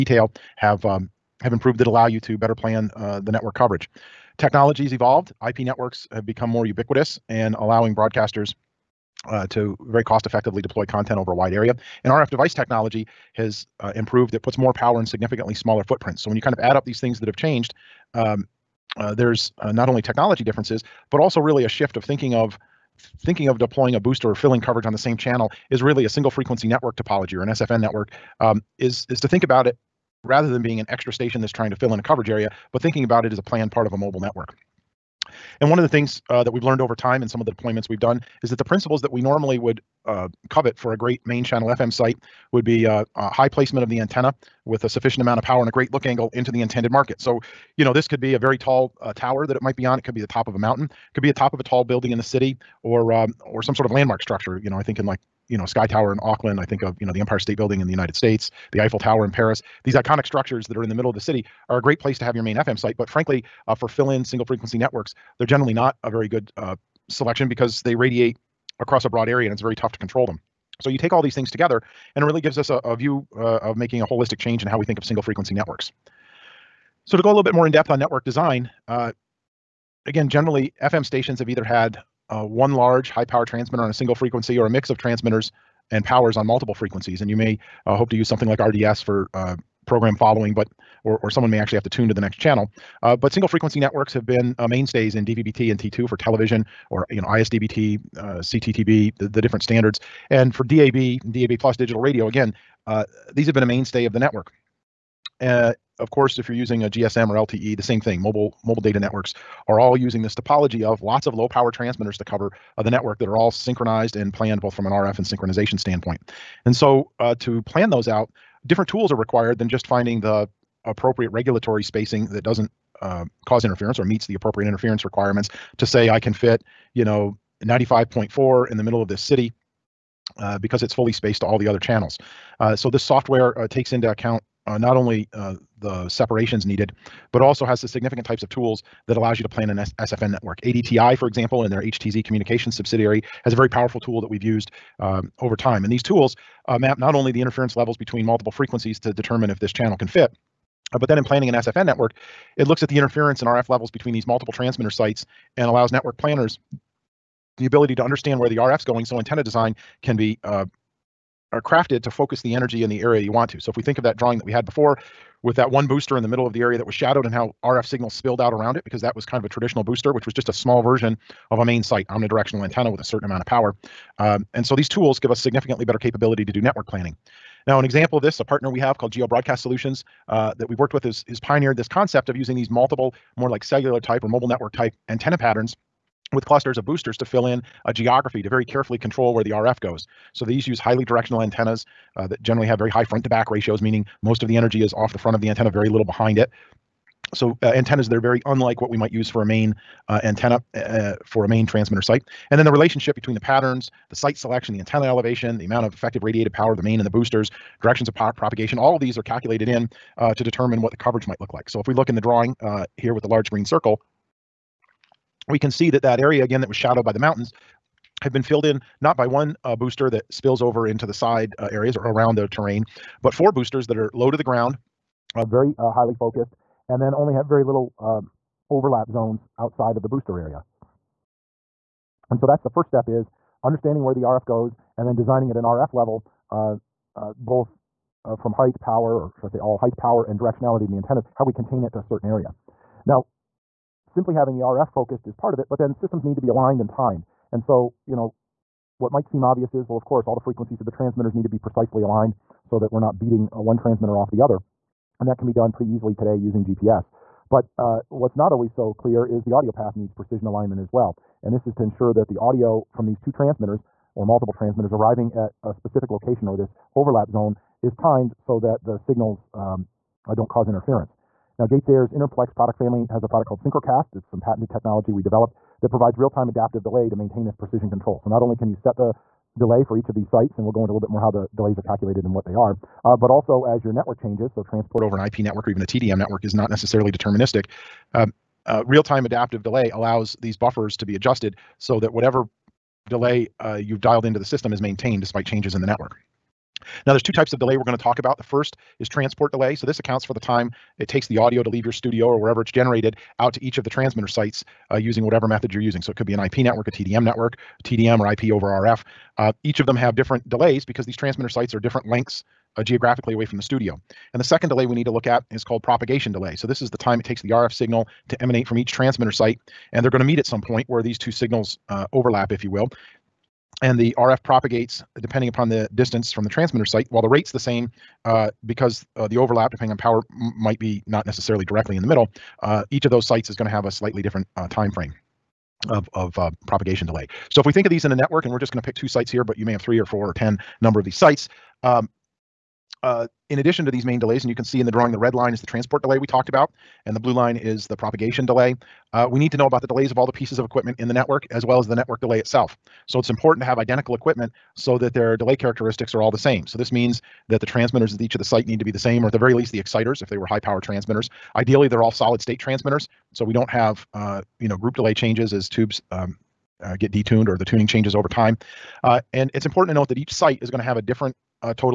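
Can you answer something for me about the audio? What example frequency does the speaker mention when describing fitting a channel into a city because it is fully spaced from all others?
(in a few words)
95.4.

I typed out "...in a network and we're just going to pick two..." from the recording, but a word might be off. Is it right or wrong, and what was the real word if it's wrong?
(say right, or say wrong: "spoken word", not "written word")
right.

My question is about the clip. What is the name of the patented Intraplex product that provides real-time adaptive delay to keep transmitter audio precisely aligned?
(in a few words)
Synchrocast.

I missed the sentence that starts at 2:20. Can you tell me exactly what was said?
ATDI, for example, and their HTZ communications subsidiary has a very powerful tool that we've used um, over time.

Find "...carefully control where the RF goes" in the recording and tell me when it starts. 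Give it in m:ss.
3:08.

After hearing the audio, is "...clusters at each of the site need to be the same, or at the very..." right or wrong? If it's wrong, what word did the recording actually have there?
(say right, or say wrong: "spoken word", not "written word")
wrong: "transmitters", not "clusters".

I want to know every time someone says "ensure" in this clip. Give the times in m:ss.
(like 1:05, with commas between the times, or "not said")
4:21.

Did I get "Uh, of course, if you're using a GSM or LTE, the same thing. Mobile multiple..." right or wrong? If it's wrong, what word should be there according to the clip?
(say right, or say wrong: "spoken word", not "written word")
wrong: "mobile", not "multiple".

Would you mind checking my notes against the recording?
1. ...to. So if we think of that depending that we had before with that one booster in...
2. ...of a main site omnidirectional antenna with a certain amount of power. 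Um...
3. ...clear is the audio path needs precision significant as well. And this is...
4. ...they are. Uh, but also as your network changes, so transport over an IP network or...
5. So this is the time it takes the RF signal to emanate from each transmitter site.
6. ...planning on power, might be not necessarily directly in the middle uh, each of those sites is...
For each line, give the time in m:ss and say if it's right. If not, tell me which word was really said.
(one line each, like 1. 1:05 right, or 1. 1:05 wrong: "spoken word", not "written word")
1. 2:43 wrong: "drawing", not "depending"
2. 2:51 right
3. 4:18 wrong: "alignment", not "significant"
4. 4:42 right
5. 5:16 right
6. 5:29 wrong: "depending", not "planning".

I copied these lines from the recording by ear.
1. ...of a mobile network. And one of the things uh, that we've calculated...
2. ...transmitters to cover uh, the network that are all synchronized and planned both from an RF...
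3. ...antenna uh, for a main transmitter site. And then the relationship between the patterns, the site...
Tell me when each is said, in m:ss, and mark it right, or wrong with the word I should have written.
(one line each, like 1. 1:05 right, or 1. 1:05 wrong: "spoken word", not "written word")
1. 0:33 wrong: "learned", not "calculated"
2. 1:51 right
3. 3:20 right.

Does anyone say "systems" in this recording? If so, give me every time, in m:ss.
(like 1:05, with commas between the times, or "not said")
4:05, 4:54.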